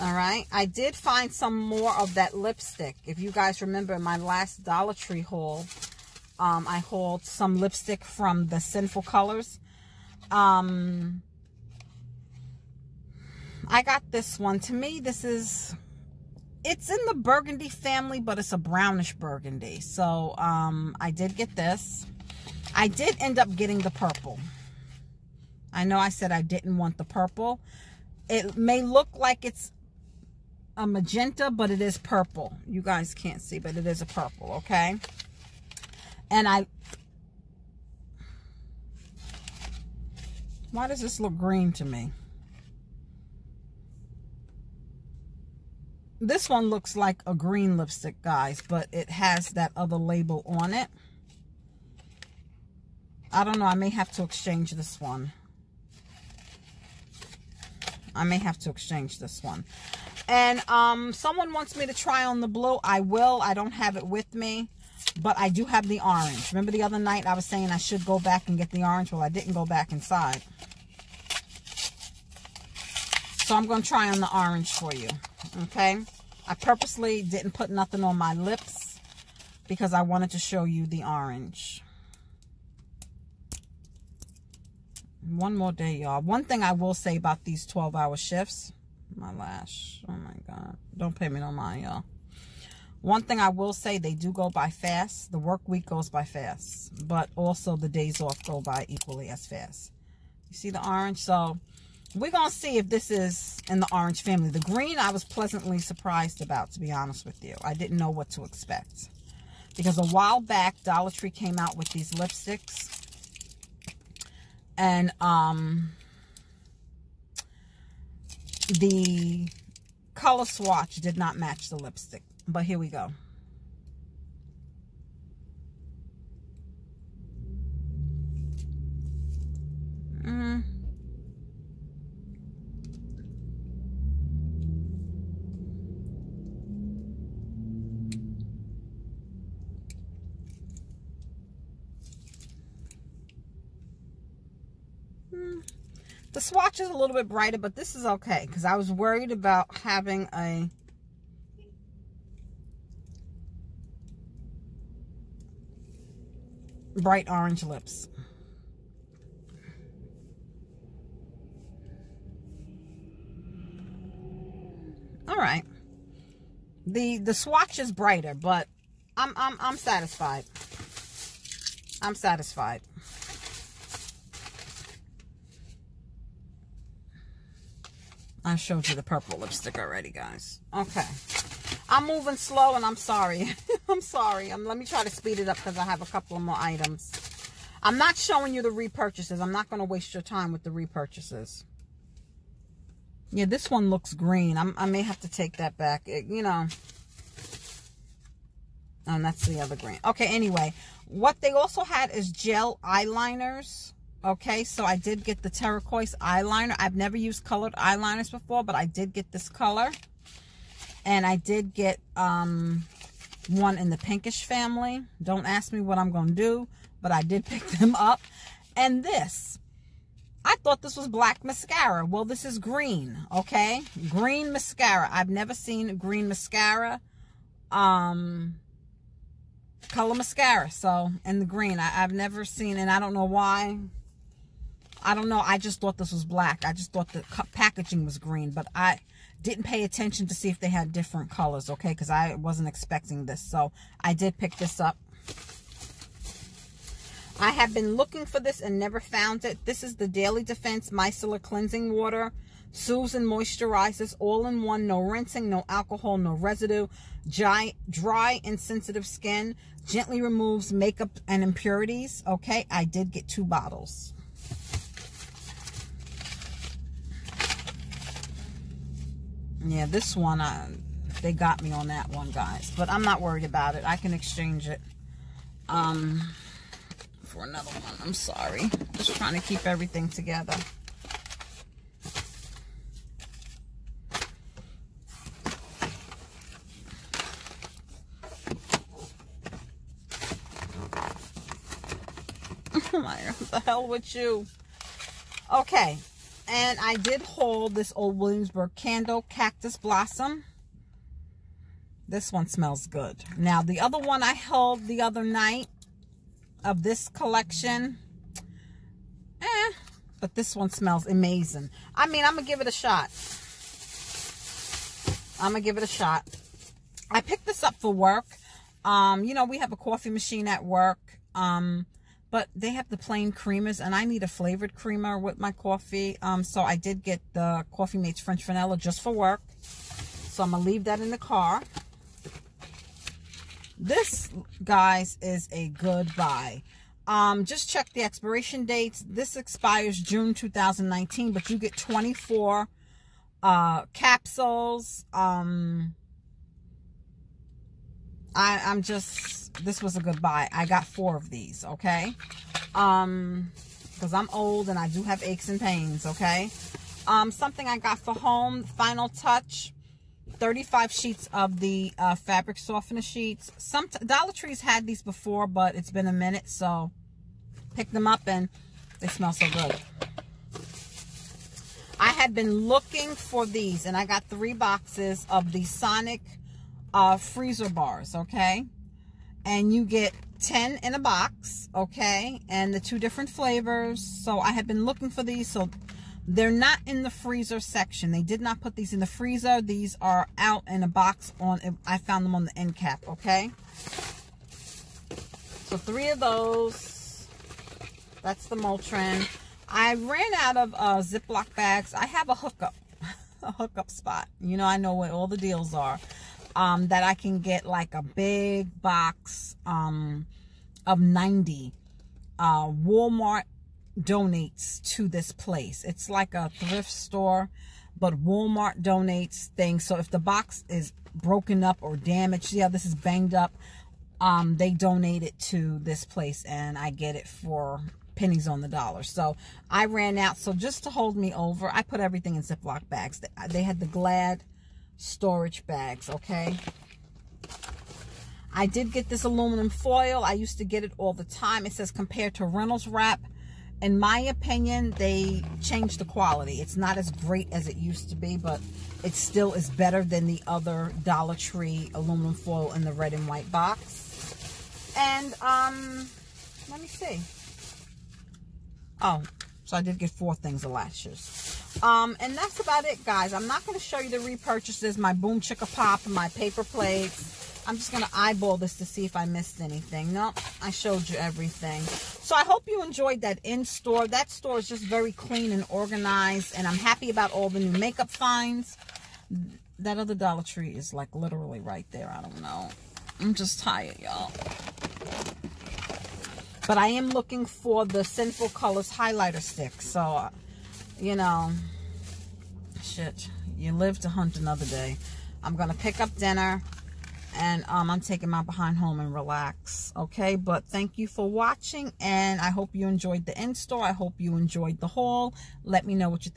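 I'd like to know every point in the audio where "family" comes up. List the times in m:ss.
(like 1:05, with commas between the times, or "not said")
0:17, 1:44, 3:34.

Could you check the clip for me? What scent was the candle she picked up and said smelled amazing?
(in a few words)
Cactus Blossom.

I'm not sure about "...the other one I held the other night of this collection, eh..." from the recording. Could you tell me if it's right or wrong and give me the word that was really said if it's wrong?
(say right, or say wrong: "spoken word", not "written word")
right.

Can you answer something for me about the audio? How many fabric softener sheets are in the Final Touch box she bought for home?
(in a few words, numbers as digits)
35.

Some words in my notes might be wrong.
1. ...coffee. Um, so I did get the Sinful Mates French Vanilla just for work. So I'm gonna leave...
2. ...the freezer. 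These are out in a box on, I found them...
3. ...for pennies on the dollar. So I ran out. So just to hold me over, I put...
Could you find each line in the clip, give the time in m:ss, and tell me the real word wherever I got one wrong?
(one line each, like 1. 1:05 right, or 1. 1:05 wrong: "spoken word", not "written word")
1. 5:25 wrong: "Coffee", not "Sinful"
2. 6:28 right
3. 7:07 right.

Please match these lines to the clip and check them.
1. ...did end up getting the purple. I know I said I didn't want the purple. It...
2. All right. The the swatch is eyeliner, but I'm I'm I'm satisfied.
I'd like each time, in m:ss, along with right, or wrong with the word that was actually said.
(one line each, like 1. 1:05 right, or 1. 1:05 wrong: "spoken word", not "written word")
1. 0:22 right
2. 2:45 wrong: "brighter", not "eyeliner".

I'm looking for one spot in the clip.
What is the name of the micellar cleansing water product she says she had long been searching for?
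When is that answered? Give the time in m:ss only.
4:10.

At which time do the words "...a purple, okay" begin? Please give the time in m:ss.
0:34.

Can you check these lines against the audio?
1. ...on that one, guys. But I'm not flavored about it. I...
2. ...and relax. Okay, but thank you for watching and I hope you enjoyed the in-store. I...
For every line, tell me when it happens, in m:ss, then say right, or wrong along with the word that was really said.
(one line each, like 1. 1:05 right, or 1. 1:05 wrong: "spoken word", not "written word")
1. 4:31 wrong: "worried", not "flavored"
2. 8:18 right.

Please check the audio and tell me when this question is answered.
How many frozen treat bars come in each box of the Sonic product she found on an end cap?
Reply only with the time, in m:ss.
6:20.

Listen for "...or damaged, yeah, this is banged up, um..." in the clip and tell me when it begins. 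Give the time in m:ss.
7:01.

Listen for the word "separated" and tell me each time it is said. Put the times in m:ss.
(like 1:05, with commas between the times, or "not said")
not said.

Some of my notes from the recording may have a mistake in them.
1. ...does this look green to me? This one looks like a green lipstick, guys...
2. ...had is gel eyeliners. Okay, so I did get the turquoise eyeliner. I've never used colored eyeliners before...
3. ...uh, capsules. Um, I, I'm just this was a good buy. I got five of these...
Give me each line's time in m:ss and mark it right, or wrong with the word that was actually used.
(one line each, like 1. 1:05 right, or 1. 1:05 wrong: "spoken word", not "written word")
1. 0:40 right
2. 3:21 right
3. 5:43 wrong: "four", not "five".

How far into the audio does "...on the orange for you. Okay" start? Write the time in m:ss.
1:14.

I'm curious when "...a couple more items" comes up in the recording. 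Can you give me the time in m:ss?
3:06.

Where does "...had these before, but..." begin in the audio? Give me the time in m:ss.
6:04.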